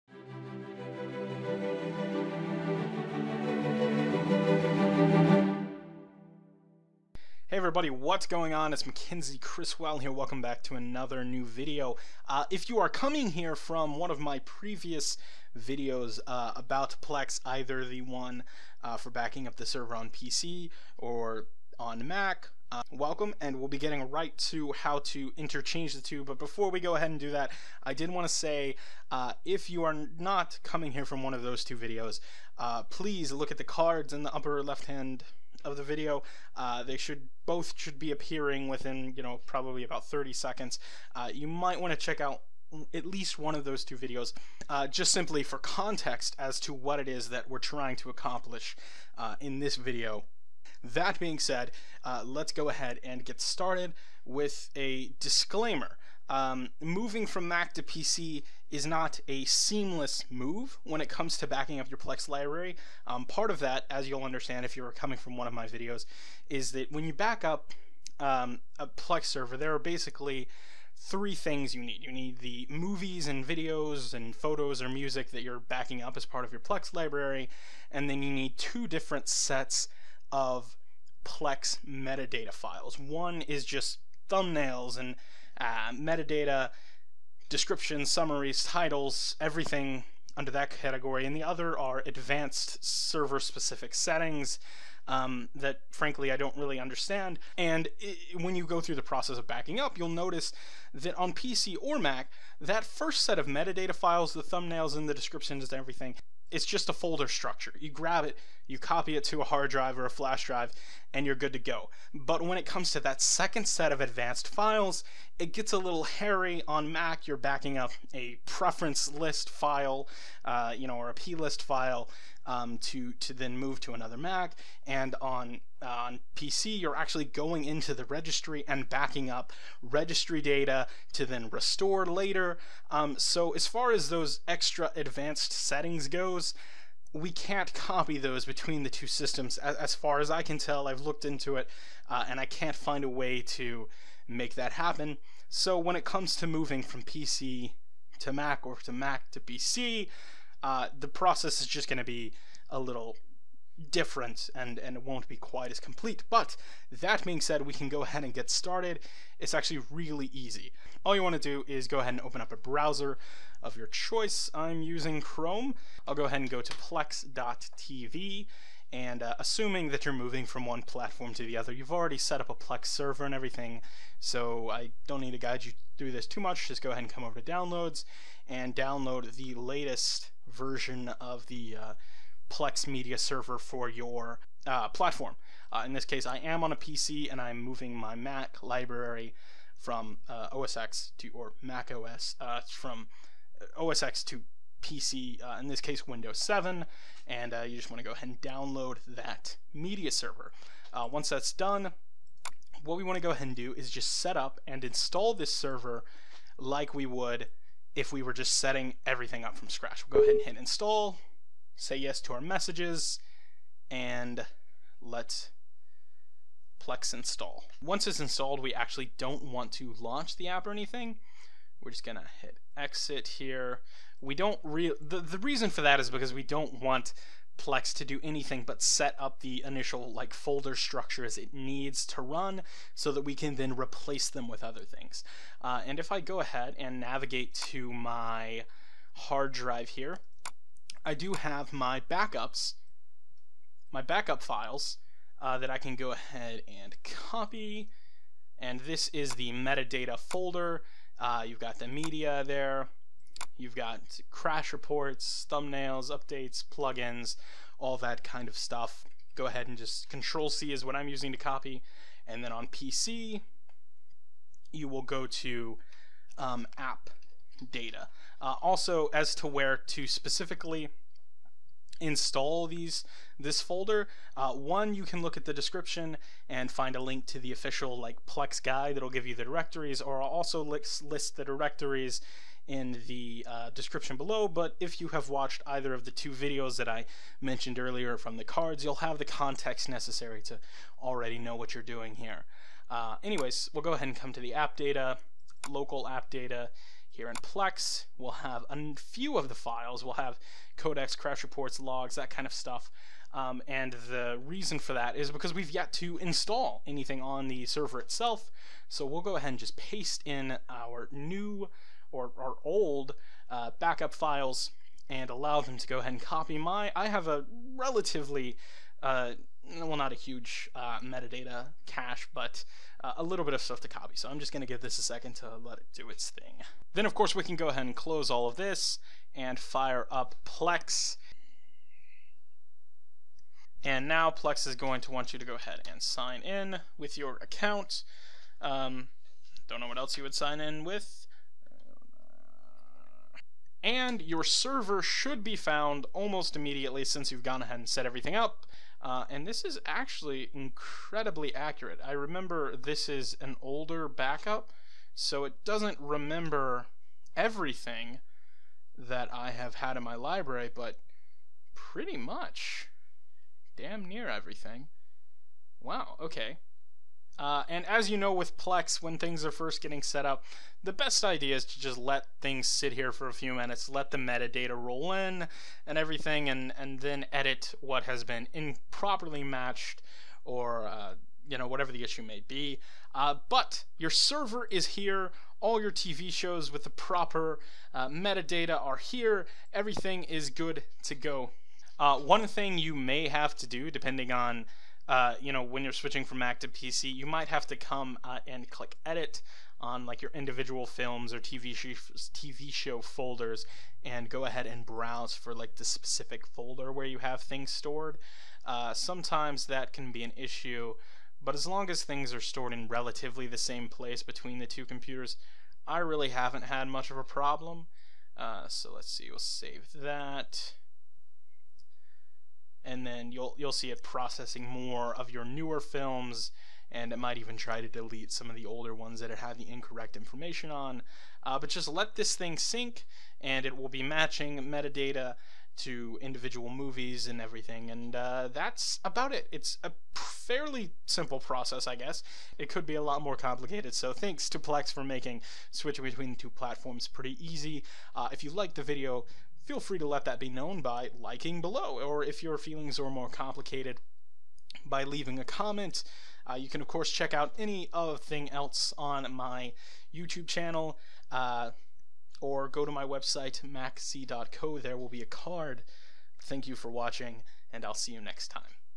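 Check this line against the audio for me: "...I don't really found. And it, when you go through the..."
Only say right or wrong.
wrong.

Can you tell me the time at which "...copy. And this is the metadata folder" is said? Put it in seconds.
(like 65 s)
247 s.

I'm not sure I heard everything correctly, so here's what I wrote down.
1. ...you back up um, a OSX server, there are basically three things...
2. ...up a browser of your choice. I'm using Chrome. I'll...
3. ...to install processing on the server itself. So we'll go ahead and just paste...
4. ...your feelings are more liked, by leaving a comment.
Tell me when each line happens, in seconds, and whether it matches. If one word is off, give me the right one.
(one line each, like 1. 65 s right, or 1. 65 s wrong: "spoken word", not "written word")
1. 67 s wrong: "Plex", not "OSX"
2. 162 s right
3. 305 s wrong: "anything", not "processing"
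4. 452 s wrong: "complicated", not "liked".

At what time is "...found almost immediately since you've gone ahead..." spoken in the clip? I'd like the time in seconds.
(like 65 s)
345 s.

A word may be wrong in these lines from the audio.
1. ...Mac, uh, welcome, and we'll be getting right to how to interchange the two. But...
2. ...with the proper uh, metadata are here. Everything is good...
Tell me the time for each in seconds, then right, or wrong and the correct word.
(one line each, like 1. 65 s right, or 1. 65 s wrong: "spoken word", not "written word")
1. 22 s right
2. 386 s right.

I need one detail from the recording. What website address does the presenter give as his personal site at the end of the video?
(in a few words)
makc.co.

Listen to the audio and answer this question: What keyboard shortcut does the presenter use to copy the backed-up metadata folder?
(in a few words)
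Control C.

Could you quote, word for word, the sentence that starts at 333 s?
And now Plex is going to want you to go ahead and sign in with your account.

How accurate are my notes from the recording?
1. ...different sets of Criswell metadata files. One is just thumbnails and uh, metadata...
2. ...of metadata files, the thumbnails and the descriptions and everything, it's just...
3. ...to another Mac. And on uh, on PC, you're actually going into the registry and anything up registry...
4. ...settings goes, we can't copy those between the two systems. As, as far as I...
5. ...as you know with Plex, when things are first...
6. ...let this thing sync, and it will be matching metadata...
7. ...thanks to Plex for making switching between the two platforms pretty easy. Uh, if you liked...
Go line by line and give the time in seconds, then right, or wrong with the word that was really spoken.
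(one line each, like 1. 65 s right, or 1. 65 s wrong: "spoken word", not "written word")
1. 78 s wrong: "Plex", not "Criswell"
2. 103 s right
3. 123 s wrong: "backing", not "anything"
4. 135 s right
5. 367 s right
6. 431 s right
7. 444 s right.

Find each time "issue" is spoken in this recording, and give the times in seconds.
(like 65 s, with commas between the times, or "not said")
382 s, 410 s.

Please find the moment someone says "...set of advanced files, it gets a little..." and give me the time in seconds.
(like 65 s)
113 s.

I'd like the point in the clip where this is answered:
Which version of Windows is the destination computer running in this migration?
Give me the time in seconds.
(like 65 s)
196 s.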